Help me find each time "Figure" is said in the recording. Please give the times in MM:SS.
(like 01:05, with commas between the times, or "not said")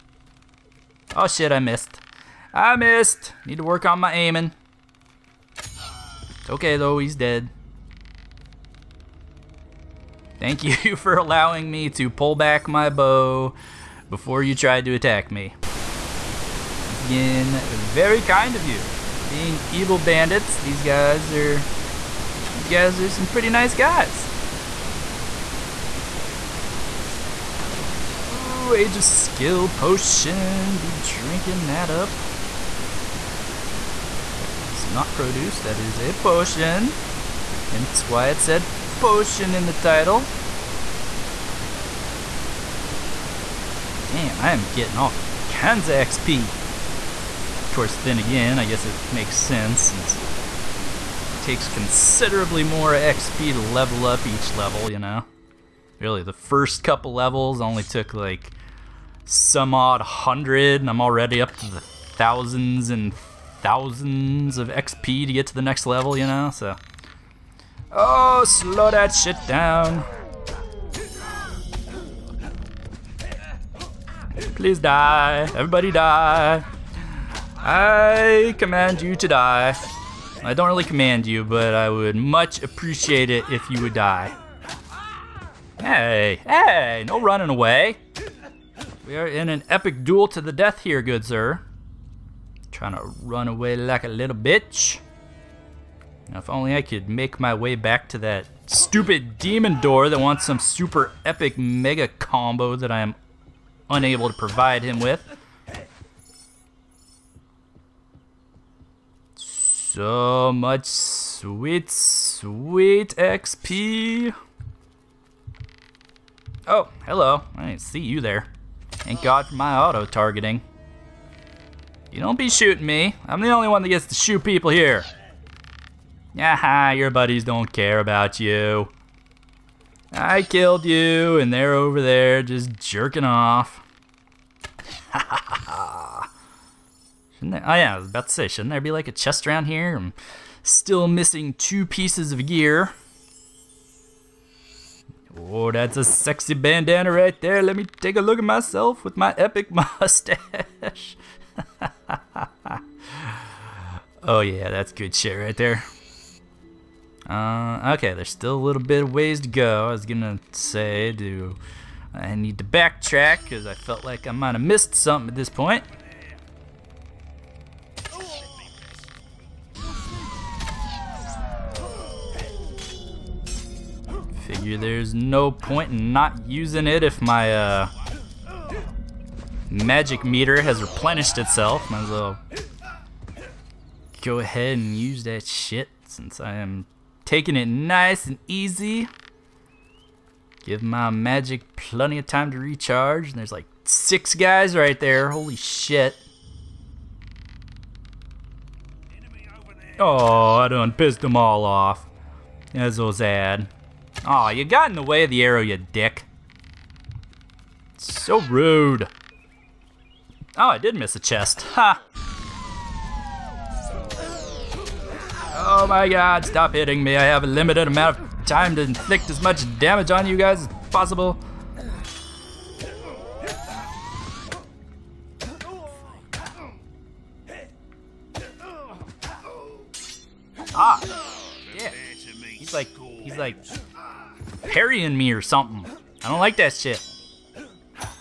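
02:54.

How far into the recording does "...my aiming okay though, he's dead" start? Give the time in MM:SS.
00:03.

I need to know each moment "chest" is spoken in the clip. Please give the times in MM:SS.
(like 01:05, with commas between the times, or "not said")
02:19, 03:31.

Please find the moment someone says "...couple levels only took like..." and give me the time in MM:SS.
00:56.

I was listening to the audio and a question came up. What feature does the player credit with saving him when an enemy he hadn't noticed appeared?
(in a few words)
auto-targeting.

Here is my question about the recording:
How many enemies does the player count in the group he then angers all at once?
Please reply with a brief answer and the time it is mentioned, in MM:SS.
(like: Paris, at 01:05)
6, at 03:13.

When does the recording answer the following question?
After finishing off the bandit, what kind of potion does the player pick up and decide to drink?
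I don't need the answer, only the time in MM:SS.
00:28.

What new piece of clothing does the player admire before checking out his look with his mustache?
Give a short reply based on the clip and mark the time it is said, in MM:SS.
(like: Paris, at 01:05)
bandana, at 02:26.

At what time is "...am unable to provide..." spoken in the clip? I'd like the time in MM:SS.
01:43.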